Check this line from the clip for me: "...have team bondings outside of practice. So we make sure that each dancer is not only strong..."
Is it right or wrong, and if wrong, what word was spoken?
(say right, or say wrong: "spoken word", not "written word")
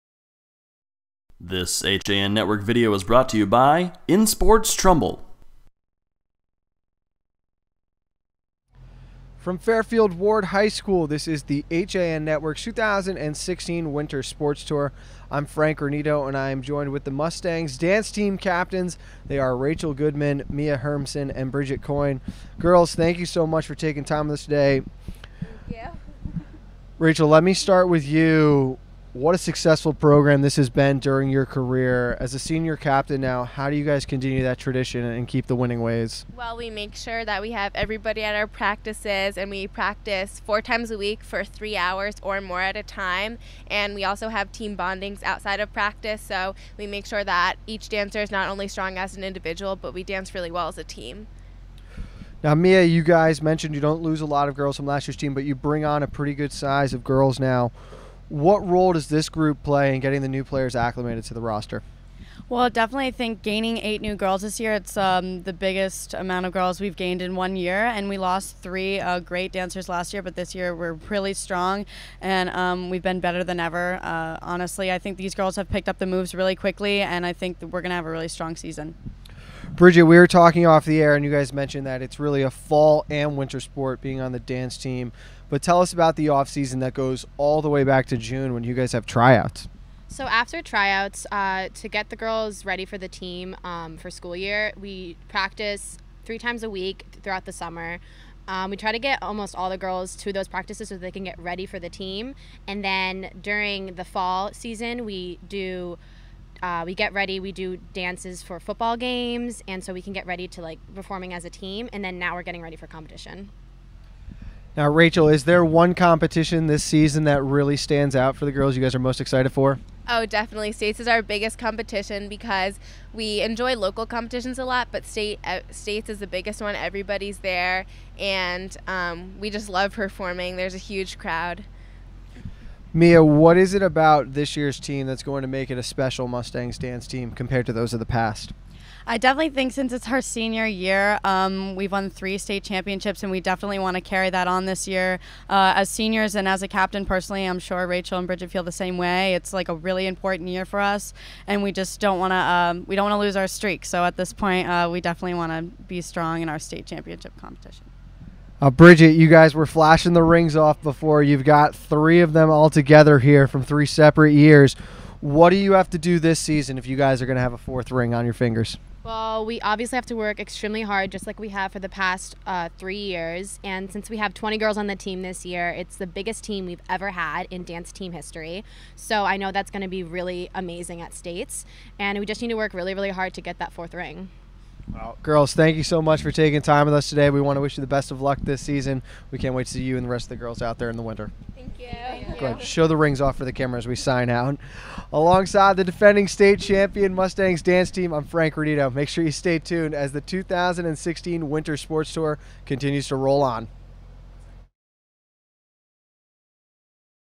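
right.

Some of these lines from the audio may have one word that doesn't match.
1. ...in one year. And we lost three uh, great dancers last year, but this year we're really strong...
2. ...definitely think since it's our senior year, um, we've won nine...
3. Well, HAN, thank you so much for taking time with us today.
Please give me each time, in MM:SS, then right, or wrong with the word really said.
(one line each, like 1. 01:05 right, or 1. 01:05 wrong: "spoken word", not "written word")
1. 01:07 right
2. 02:19 wrong: "three", not "nine"
3. 03:04 wrong: "Girls", not "HAN".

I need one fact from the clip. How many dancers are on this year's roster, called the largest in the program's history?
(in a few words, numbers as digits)
20.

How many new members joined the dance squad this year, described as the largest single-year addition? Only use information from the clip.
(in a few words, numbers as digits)
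8.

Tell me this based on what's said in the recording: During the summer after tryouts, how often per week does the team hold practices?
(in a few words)
3 times a week.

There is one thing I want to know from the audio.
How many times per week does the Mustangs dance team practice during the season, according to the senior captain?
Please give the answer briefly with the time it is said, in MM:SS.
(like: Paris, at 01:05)
4, at 00:40.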